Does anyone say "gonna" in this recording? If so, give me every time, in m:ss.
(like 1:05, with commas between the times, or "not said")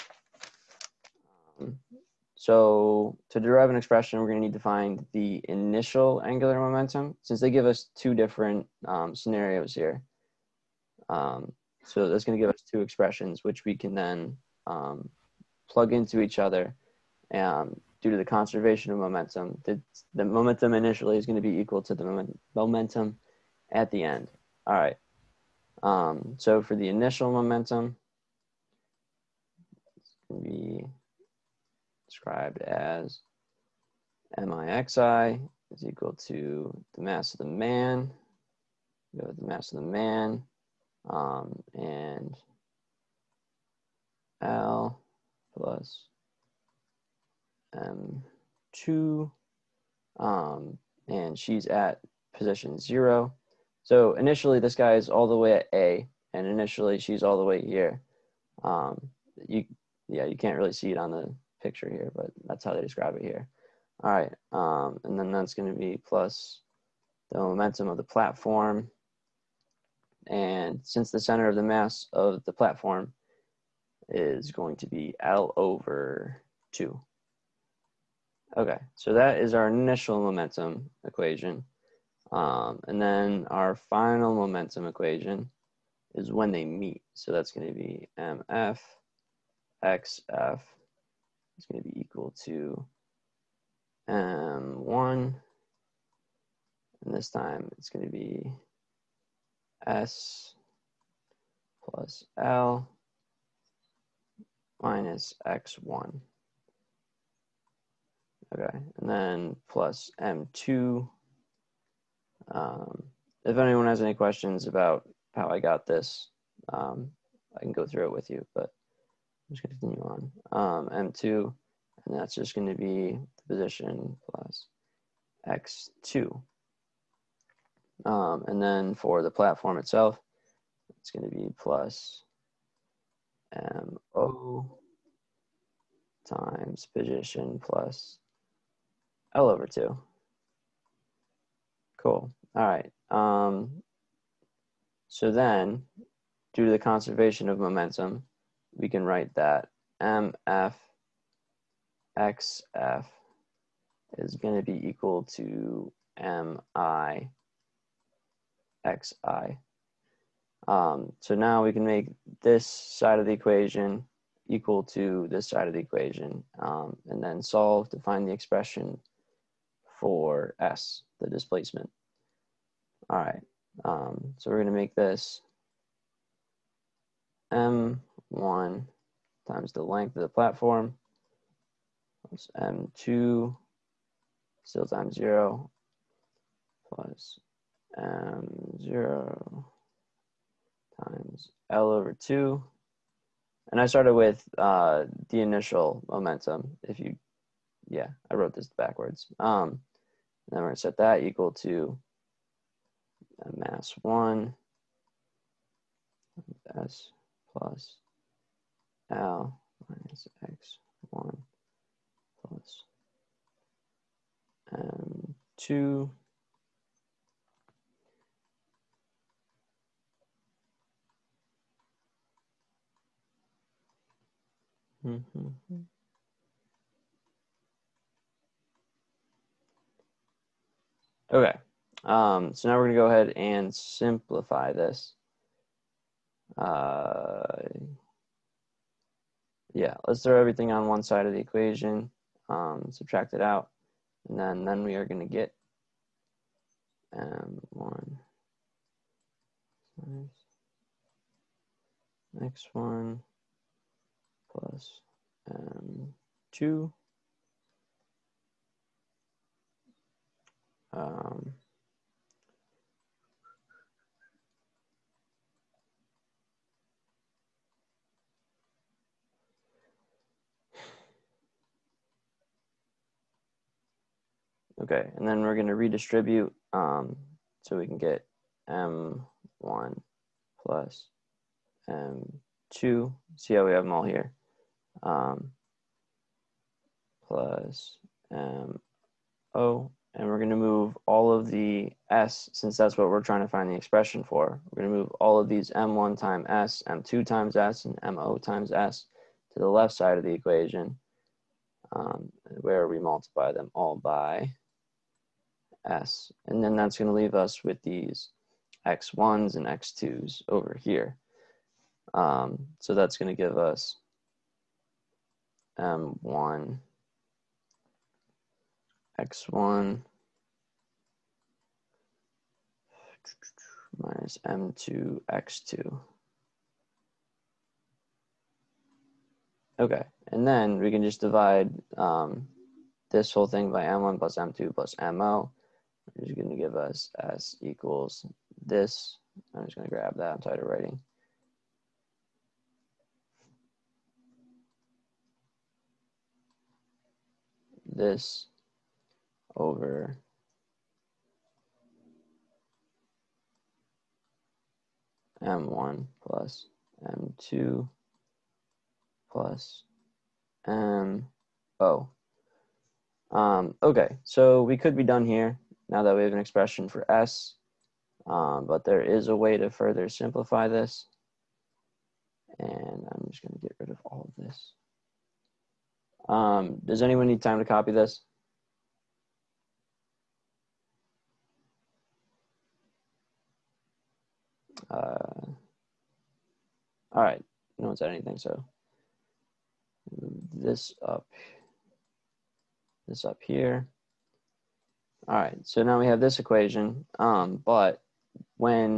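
0:04, 0:12, 0:21, 1:05, 2:54, 3:52, 4:05.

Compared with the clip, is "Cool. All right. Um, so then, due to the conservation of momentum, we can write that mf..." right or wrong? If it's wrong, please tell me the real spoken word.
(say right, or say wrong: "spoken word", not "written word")
right.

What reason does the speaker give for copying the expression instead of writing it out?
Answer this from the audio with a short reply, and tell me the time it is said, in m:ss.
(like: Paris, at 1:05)
Tired of writing, at 5:40.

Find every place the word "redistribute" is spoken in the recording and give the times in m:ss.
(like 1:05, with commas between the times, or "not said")
4:35.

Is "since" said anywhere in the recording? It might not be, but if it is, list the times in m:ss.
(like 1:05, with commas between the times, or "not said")
0:07, 1:10, 4:52.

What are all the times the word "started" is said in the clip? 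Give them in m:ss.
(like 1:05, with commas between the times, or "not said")
3:13.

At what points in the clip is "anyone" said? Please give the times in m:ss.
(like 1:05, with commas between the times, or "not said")
1:53, 6:17.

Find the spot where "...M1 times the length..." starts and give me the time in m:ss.
2:57.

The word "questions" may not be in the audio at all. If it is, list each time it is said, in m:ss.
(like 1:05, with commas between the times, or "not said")
1:54.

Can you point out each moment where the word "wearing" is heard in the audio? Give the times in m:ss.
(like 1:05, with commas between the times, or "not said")
not said.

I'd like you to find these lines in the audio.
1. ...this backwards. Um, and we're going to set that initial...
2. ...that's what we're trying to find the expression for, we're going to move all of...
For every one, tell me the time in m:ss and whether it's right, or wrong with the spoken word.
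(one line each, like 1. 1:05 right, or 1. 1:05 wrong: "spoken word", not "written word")
1. 3:18 wrong: "equal", not "initial"
2. 4:52 right.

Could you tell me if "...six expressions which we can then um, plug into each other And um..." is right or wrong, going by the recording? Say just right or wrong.
wrong.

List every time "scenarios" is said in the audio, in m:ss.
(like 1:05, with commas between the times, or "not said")
0:09.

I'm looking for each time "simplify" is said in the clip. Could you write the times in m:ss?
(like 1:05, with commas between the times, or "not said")
3:53, 6:10.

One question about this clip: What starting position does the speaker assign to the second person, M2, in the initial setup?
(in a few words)
0.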